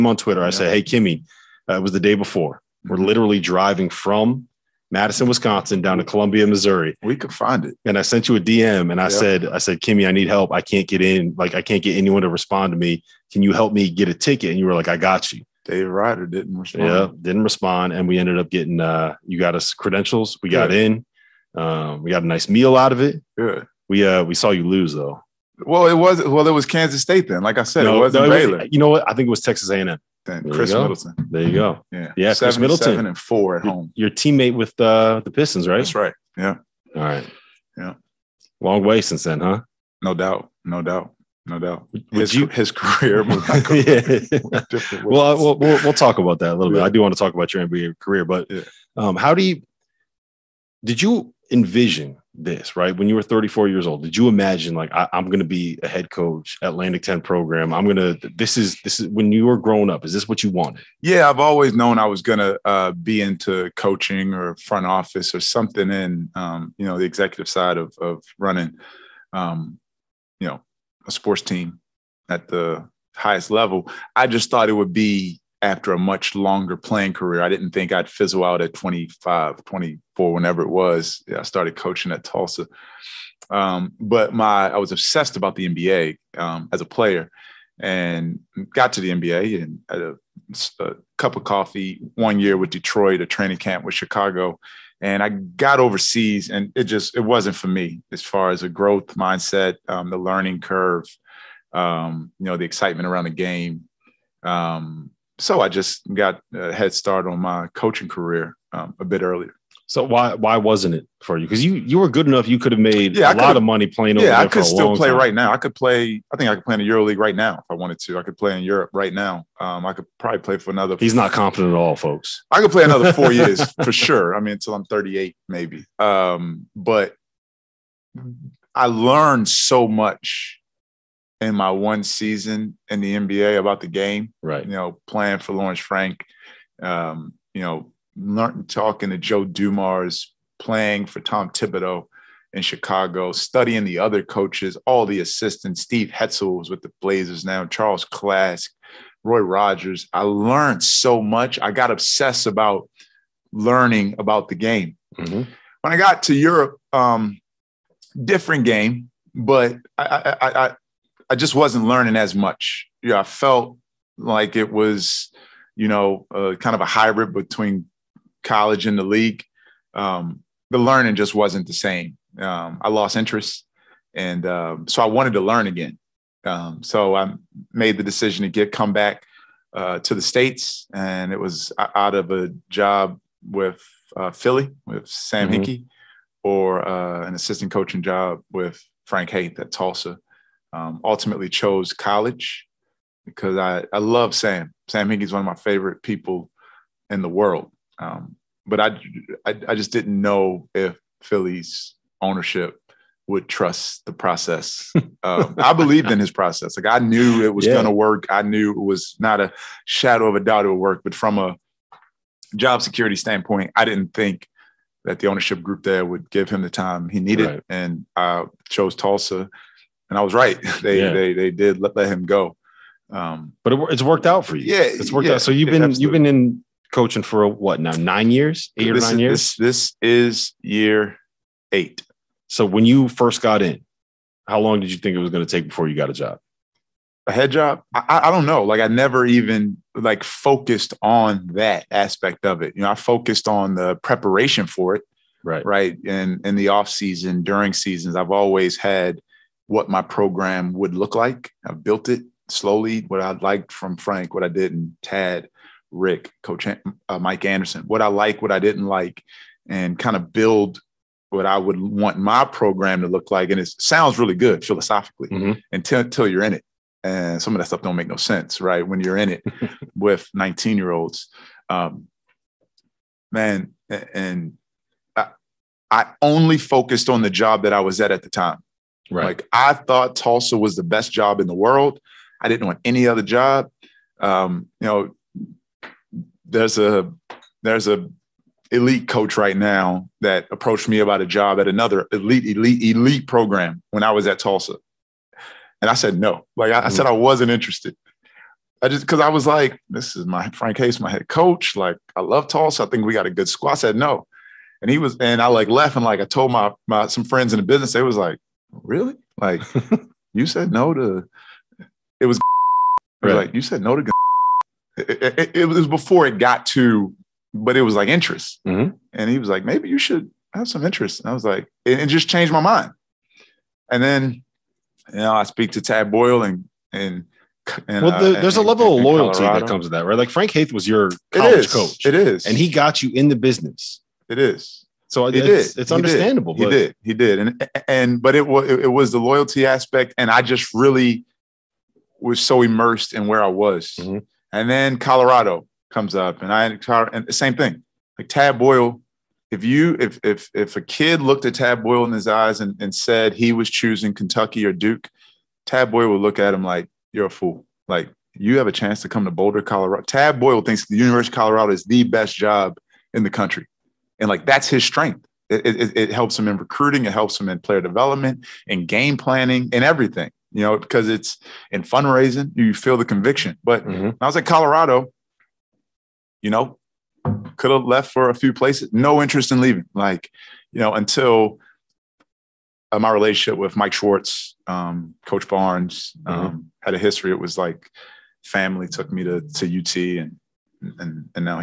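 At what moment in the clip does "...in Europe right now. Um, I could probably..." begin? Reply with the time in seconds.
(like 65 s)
118 s.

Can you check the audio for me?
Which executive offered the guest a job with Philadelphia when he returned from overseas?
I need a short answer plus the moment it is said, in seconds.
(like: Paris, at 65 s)
Sam Hinkie, at 194 s.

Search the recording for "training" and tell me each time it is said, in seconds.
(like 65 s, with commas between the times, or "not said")
93 s.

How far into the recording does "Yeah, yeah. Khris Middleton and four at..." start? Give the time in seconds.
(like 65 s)
31 s.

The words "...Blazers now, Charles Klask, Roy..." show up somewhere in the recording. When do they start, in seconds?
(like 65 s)
147 s.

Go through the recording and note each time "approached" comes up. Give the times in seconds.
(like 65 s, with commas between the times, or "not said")
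290 s.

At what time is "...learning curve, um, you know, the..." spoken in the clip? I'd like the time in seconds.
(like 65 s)
100 s.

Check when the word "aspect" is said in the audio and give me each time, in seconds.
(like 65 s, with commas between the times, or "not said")
241 s, 339 s.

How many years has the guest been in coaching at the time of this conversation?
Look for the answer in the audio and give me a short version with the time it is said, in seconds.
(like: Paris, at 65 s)
8, at 230 s.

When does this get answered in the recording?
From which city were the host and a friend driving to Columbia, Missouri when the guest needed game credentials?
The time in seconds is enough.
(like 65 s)
4 s.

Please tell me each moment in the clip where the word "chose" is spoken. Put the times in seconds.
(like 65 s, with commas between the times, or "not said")
191 s, 218 s.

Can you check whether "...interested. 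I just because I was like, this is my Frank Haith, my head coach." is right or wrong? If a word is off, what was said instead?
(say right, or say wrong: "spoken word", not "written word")
right.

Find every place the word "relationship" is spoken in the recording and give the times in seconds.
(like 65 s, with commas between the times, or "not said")
383 s.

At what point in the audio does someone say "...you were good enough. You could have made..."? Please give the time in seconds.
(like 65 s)
111 s.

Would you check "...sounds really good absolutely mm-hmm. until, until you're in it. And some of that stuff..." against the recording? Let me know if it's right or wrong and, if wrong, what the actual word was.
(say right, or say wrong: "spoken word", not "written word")
wrong: "philosophically", not "absolutely".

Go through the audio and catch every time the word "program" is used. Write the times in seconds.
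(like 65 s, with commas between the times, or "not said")
57 s, 250 s, 262 s, 293 s.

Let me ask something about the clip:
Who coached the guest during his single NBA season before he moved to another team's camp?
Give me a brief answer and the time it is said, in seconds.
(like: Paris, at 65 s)
Lawrence Frank, at 135 s.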